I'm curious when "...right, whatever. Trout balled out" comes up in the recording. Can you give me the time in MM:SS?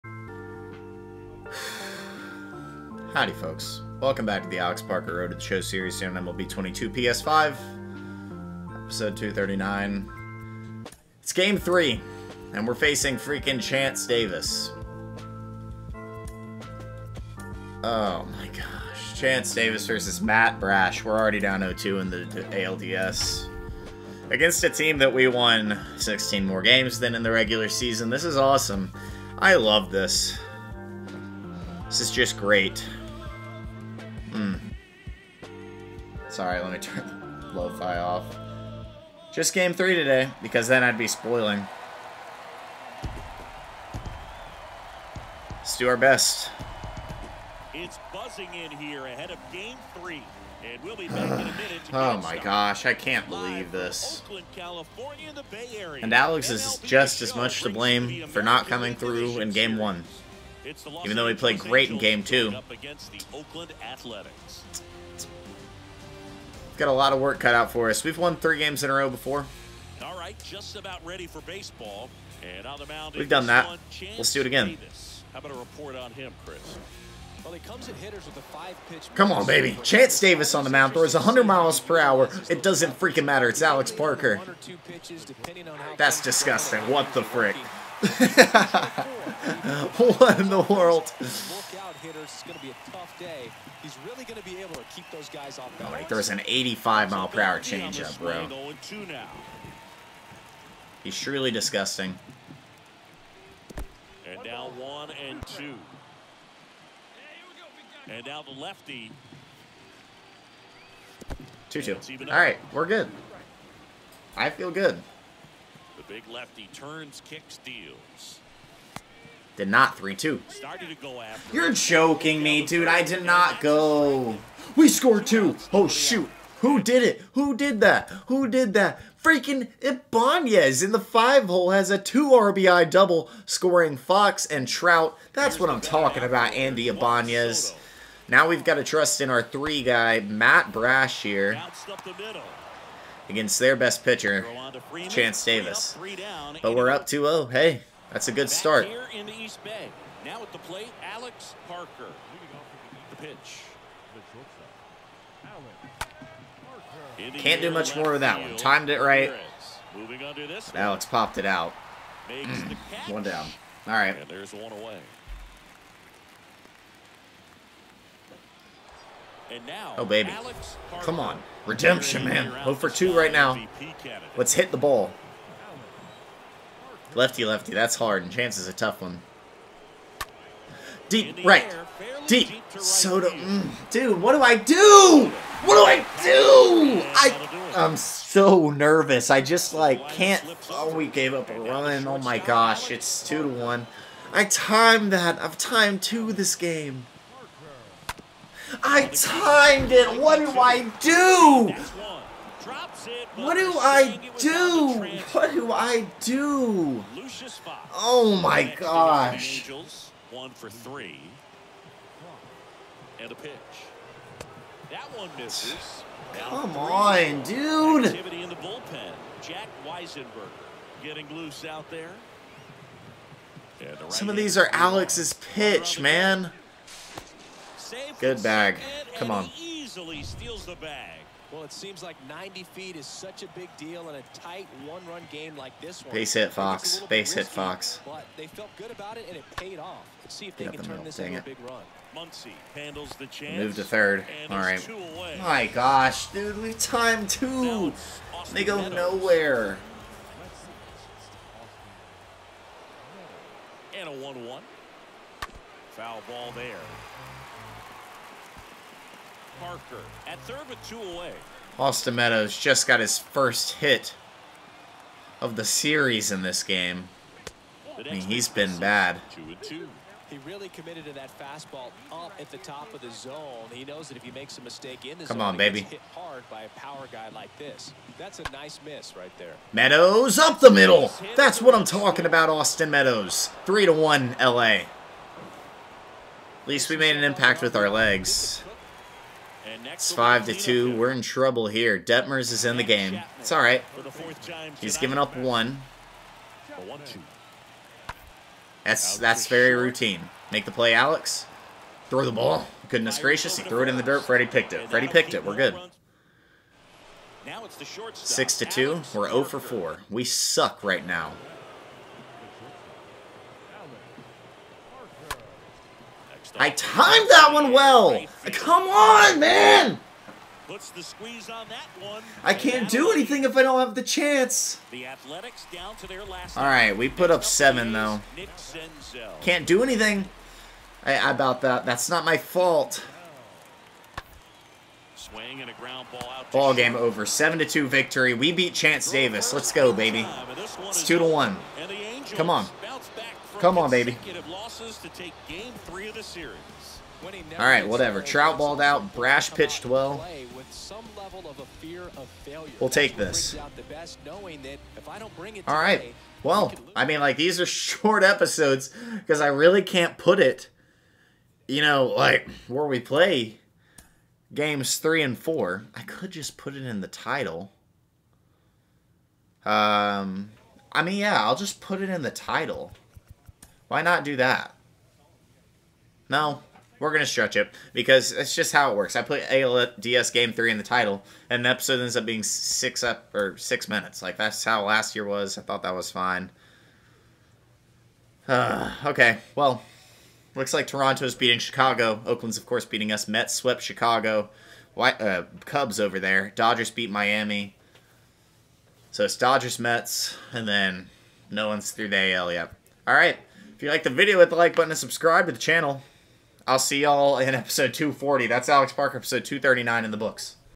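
05:47.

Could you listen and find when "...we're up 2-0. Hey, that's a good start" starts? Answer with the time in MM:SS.
02:26.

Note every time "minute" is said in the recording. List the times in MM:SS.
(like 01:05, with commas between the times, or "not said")
00:51, 06:23.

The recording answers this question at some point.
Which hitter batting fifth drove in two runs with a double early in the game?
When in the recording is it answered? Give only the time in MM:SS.
02:16.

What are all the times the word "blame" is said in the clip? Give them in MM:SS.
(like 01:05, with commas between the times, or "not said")
00:57.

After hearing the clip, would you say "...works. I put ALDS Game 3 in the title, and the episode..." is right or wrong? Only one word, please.
right.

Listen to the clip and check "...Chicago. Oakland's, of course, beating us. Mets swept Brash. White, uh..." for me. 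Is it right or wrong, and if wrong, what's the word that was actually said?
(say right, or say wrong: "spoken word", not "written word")
wrong: "Chicago", not "Brash".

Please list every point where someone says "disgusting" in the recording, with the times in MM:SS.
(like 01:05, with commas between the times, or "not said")
01:26, 01:41.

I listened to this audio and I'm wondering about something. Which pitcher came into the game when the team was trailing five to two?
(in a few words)
Detmers.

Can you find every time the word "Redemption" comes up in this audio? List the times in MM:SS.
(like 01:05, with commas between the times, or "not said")
02:51.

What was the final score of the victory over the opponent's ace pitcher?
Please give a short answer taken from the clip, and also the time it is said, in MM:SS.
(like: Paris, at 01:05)
7 to 2, at 05:37.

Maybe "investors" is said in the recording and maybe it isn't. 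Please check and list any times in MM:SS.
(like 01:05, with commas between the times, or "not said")
not said.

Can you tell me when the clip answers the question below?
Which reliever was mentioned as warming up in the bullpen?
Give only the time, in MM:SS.
03:39.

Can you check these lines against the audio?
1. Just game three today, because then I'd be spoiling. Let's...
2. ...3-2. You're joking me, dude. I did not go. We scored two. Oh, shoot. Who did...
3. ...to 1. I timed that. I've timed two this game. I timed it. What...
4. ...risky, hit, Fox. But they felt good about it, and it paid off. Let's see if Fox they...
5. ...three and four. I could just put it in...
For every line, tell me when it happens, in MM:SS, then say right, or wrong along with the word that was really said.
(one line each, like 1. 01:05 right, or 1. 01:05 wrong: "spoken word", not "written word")
1. 00:39 right
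2. 01:59 right
3. 03:13 right
4. 03:57 wrong: "Get", not "Fox"
5. 06:04 right.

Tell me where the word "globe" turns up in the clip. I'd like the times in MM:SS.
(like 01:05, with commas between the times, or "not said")
not said.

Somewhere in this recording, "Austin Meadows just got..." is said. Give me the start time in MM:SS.
04:21.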